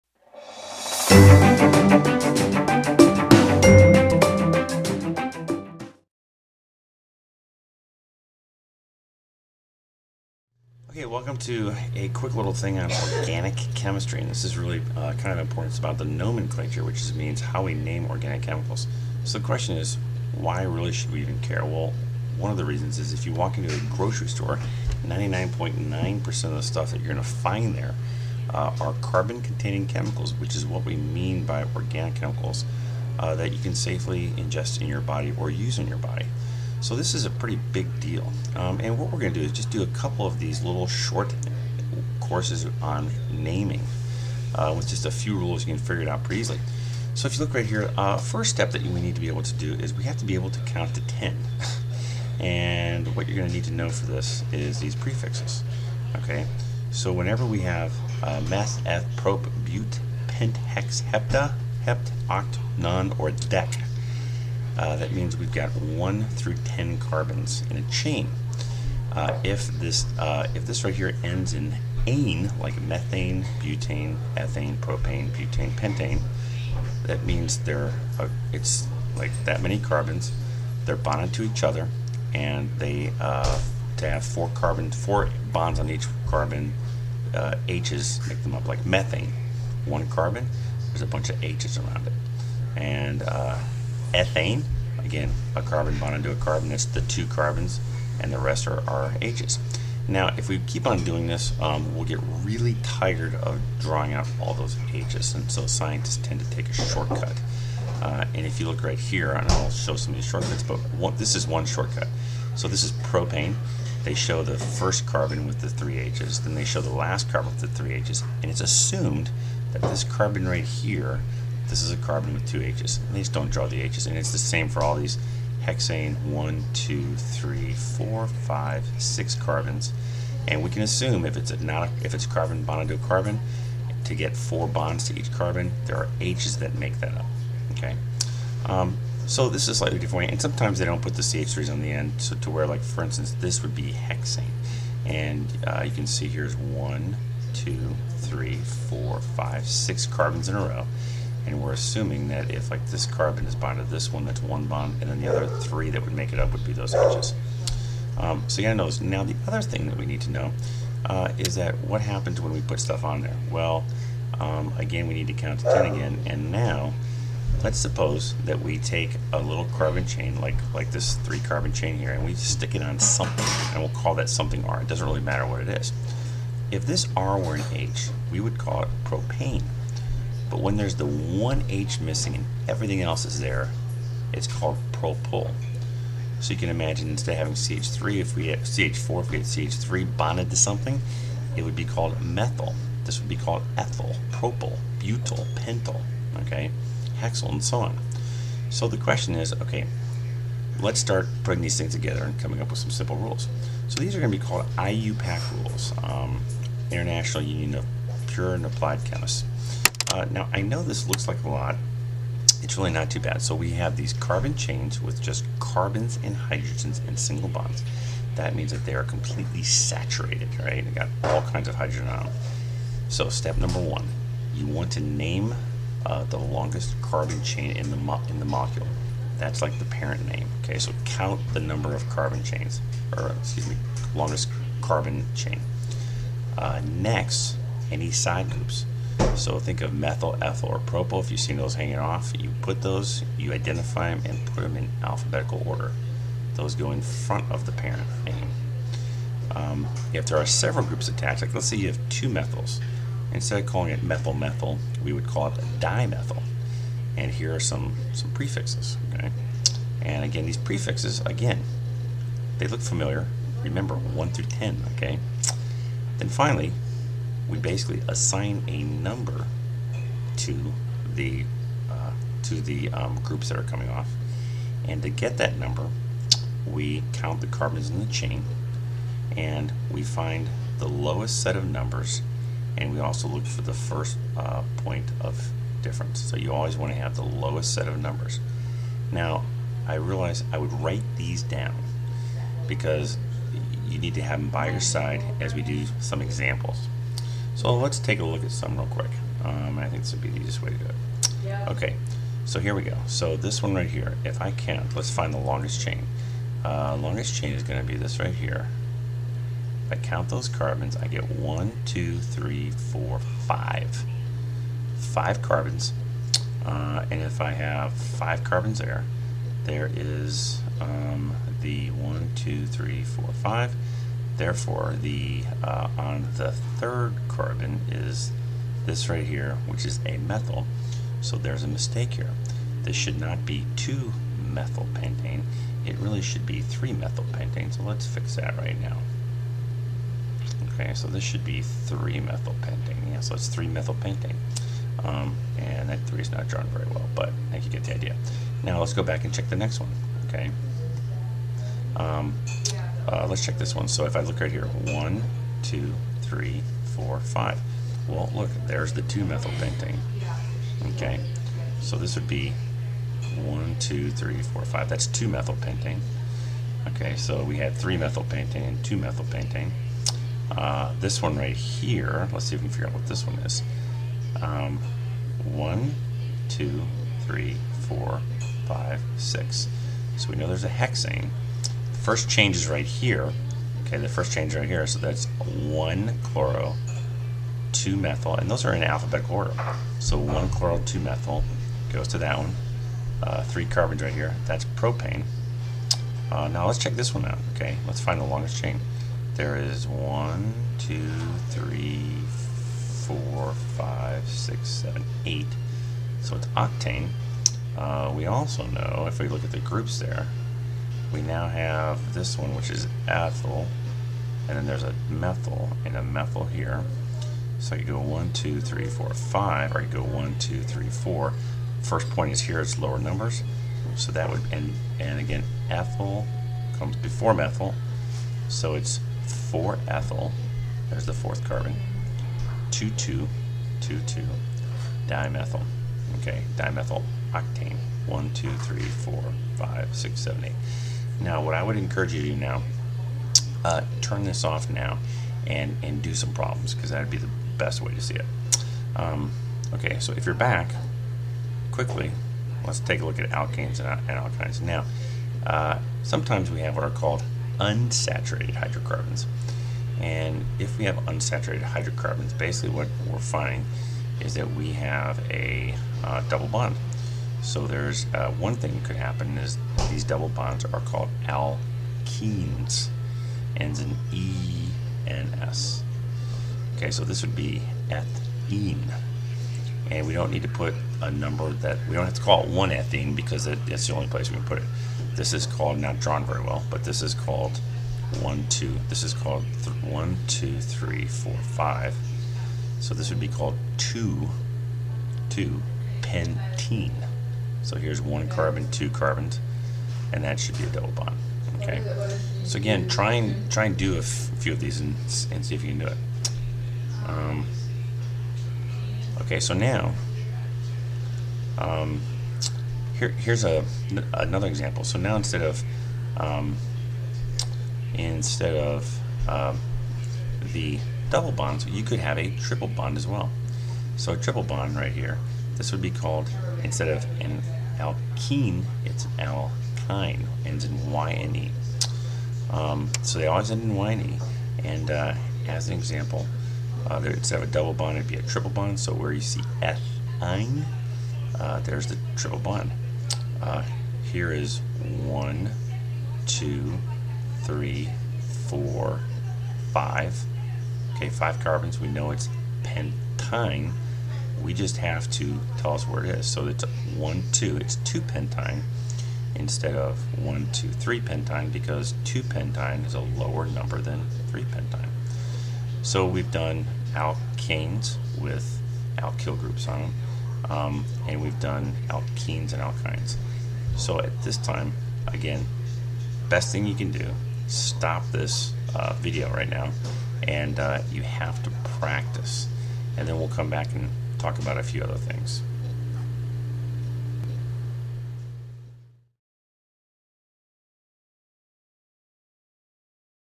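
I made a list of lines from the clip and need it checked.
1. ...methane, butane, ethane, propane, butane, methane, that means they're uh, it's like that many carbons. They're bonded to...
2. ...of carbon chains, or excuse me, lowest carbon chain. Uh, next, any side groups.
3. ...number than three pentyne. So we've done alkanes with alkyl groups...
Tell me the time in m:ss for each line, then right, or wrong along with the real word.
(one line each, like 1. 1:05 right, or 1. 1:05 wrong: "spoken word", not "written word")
1. 1:12 wrong: "pentane", not "methane"
2. 3:51 wrong: "longest", not "lowest"
3. 9:23 right.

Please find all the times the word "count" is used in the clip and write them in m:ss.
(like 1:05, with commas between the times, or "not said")
0:50, 2:45, 3:51, 4:37, 5:04, 5:10.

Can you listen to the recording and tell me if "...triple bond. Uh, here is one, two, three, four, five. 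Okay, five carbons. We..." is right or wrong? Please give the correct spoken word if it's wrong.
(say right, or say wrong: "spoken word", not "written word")
right.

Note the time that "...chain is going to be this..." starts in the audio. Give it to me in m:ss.
5:07.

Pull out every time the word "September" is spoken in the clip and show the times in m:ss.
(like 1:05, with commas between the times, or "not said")
not said.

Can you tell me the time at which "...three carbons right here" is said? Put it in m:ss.
6:33.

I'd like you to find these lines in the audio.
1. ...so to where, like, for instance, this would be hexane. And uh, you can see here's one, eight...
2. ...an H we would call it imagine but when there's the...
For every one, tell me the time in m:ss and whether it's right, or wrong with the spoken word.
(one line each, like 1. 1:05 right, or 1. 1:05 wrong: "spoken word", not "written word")
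1. 2:22 wrong: "two", not "eight"
2. 2:57 wrong: "propane", not "imagine".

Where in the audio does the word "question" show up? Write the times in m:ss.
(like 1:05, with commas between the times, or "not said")
0:19, 3:18.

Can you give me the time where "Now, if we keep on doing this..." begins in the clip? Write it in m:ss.
1:40.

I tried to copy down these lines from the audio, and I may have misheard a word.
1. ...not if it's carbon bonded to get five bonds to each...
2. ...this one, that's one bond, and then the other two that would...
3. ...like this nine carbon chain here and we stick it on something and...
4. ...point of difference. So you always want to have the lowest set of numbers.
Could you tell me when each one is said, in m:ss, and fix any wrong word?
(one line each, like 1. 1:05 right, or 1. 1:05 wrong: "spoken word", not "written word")
1. 2:11 wrong: "four", not "five"
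2. 2:33 wrong: "three", not "two"
3. 2:50 wrong: "three", not "nine"
4. 4:44 right.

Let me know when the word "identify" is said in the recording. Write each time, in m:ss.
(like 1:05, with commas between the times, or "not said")
4:03.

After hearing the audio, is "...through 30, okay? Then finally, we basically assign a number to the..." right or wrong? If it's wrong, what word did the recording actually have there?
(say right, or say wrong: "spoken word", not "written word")
wrong: "10", not "30".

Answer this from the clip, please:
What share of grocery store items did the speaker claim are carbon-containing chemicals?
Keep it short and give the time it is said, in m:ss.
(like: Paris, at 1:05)
99.9%, at 0:25.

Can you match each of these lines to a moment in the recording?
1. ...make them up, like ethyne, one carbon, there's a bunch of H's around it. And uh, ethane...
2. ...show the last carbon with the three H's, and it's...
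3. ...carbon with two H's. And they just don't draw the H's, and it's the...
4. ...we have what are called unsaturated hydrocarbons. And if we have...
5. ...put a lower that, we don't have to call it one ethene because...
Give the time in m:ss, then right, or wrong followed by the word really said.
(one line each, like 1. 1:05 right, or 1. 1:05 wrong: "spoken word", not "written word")
1. 1:28 wrong: "methane", not "ethyne"
2. 1:56 right
3. 2:01 right
4. 7:36 right
5. 8:00 wrong: "number", not "lower".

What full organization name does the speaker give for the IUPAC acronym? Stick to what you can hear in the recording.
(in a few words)
International Union of Pure and Applied Chemists.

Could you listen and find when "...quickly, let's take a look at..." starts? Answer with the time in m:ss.
7:31.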